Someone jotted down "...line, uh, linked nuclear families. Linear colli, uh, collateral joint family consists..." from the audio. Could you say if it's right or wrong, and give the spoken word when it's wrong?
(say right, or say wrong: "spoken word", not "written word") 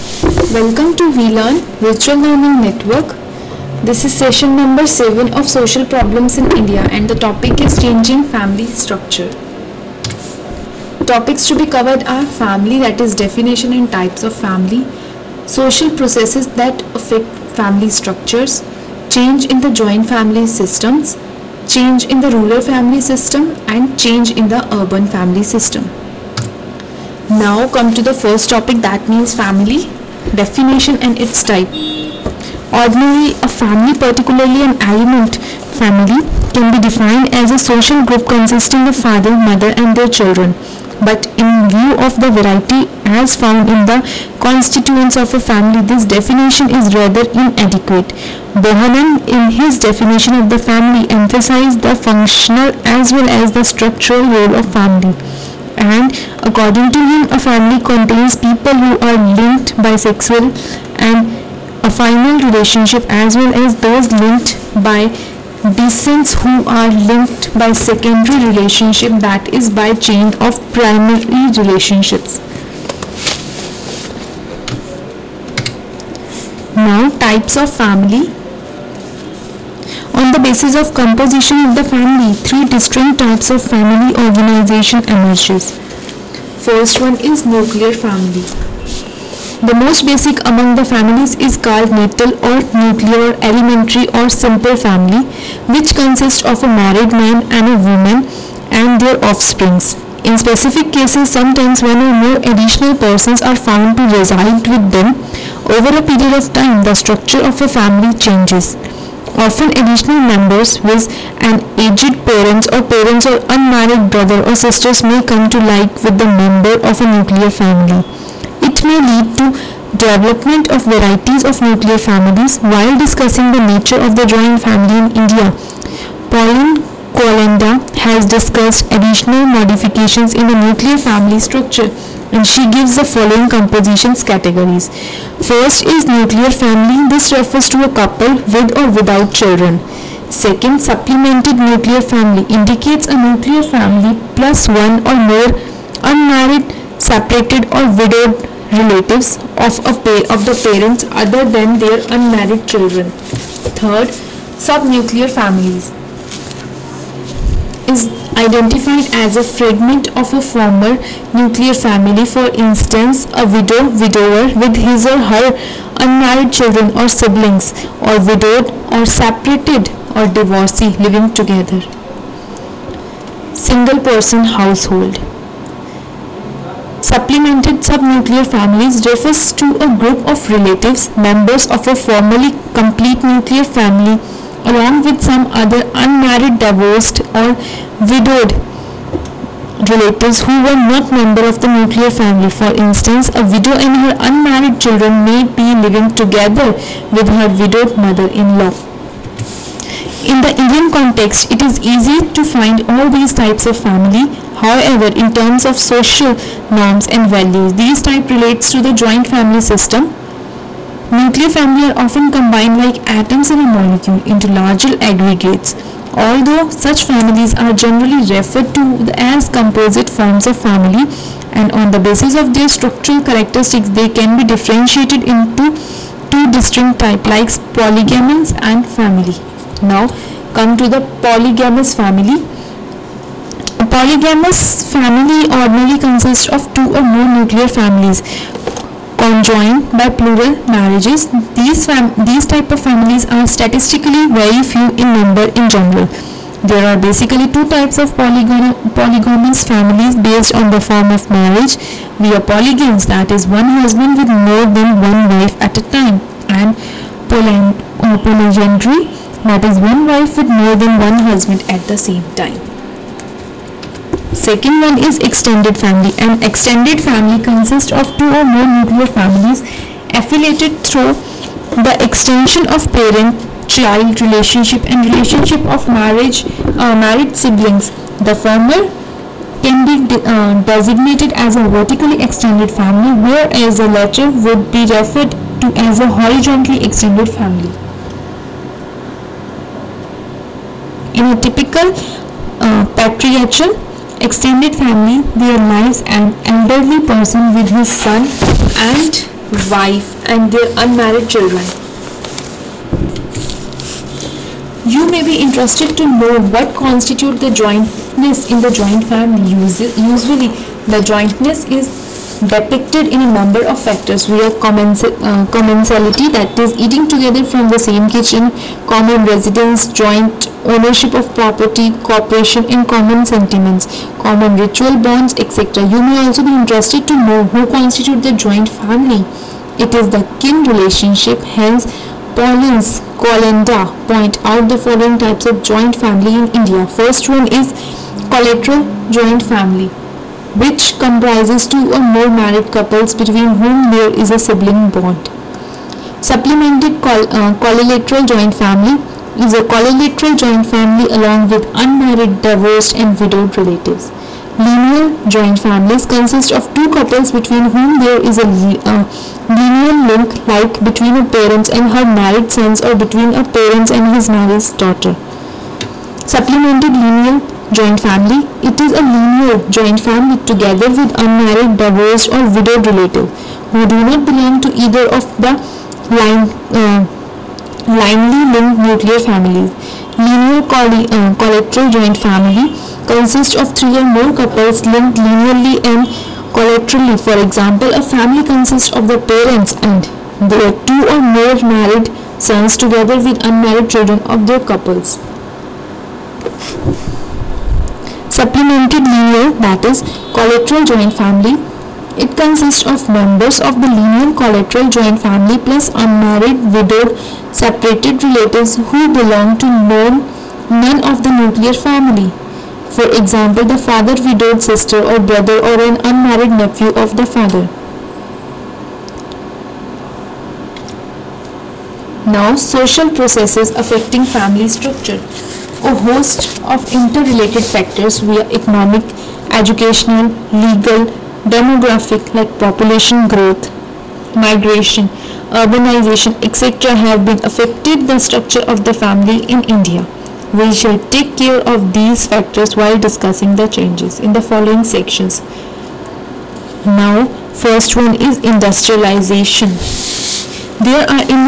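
right.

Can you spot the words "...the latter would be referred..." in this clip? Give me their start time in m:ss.
4:43.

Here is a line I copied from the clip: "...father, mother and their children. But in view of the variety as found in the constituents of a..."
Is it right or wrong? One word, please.
right.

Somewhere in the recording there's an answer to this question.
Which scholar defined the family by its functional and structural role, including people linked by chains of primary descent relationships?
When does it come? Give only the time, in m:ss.
0:48.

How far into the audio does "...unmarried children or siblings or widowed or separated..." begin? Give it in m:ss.
2:46.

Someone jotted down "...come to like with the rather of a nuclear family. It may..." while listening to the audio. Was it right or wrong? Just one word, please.
wrong.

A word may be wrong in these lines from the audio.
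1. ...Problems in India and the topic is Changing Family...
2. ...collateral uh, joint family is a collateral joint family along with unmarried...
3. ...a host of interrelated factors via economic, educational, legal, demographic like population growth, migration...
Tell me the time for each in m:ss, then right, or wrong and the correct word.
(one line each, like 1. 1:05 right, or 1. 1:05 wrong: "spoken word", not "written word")
1. 0:05 right
2. 5:47 right
3. 7:05 right.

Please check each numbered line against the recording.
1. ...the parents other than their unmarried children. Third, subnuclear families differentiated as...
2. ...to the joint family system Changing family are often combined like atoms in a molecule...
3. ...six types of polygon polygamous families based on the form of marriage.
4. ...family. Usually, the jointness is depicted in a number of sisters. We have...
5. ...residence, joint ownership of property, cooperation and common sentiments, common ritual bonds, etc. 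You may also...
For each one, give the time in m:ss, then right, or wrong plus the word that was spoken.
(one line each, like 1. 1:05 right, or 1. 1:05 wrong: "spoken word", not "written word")
1. 2:30 wrong: "identified", not "differentiated"
2. 3:28 wrong: "Nuclear", not "Changing"
3. 4:07 wrong: "two", not "six"
4. 5:09 wrong: "factors", not "sisters"
5. 5:19 right.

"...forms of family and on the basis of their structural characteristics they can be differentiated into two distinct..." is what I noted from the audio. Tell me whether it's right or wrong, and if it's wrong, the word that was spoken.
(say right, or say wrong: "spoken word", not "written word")
right.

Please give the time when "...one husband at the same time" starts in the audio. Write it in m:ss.
4:20.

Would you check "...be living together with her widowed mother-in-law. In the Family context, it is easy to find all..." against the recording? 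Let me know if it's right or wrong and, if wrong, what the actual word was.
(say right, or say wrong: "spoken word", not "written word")
wrong: "Indian", not "Family".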